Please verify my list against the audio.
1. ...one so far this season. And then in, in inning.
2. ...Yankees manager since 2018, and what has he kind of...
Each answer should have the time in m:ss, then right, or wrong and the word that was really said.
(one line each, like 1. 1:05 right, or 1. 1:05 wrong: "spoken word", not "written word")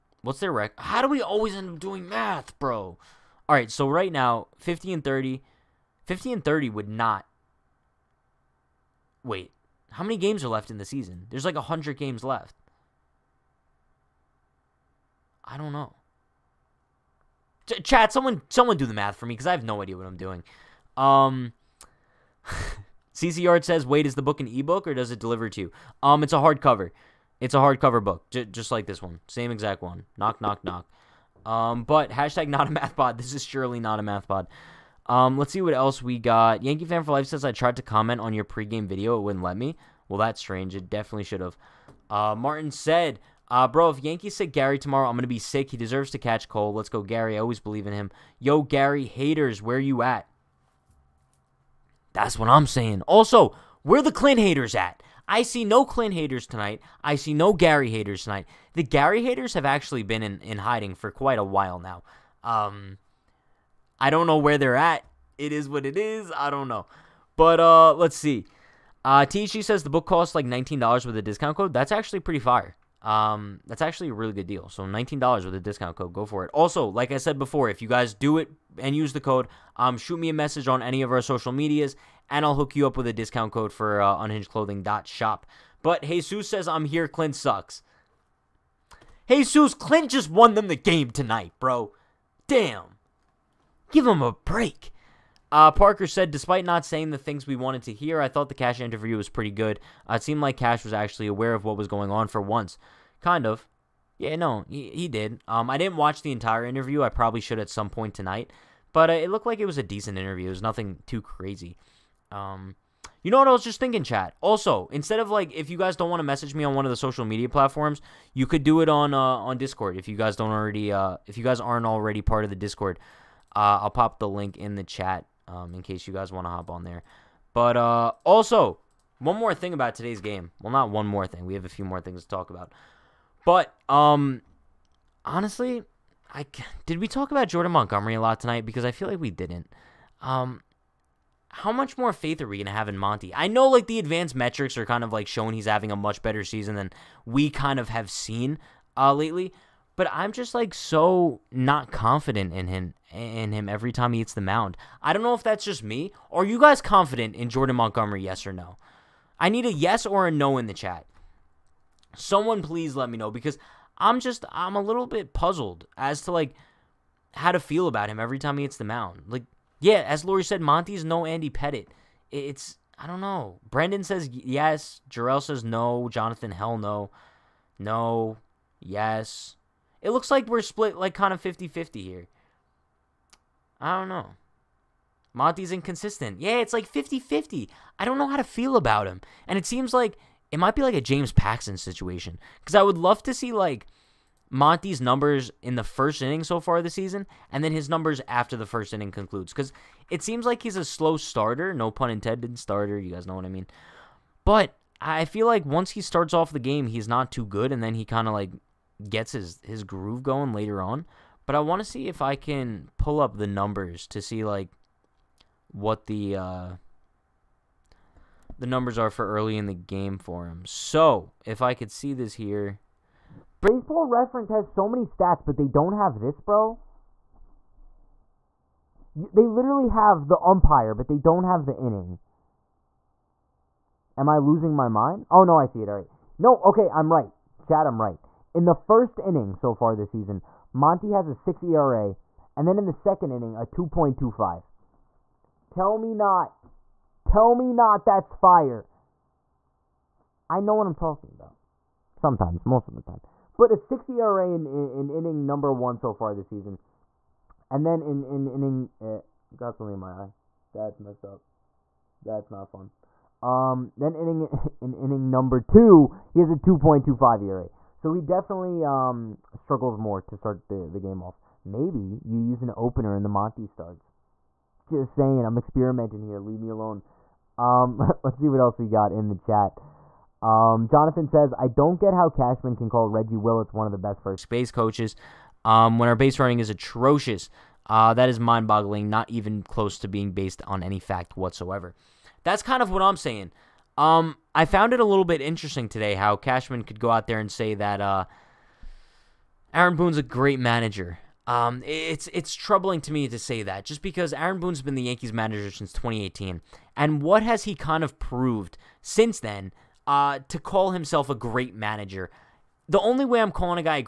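1. 4:15 right
2. 5:05 right.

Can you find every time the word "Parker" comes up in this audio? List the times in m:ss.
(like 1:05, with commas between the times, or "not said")
1:35.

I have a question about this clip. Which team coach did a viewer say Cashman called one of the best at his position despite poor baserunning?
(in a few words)
Reggie Willits.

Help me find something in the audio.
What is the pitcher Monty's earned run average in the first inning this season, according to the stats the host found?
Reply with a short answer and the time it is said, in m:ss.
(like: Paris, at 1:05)
6, at 4:01.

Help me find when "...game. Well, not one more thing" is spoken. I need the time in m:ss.
2:10.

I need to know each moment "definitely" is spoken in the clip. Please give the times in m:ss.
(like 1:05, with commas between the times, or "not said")
0:40, 4:28.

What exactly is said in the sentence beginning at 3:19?
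Because it seems like he's a slow starter, no pun intended, starter.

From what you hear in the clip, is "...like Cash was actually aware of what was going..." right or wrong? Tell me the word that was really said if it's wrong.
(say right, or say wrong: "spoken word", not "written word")
right.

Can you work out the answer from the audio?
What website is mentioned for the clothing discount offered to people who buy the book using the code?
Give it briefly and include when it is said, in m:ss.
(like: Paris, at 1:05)
unhingedclothing.shop, at 1:24.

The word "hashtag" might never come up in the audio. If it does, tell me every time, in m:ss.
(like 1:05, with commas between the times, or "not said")
0:32.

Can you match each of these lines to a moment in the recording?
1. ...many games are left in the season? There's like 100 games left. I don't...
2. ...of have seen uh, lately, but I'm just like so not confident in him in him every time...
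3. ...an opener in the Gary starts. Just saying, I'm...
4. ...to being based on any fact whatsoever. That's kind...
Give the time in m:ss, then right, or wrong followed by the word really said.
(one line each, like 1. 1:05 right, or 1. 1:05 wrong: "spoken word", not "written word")
1. 0:10 right
2. 2:27 right
3. 4:32 wrong: "Monty", not "Gary"
4. 4:49 right.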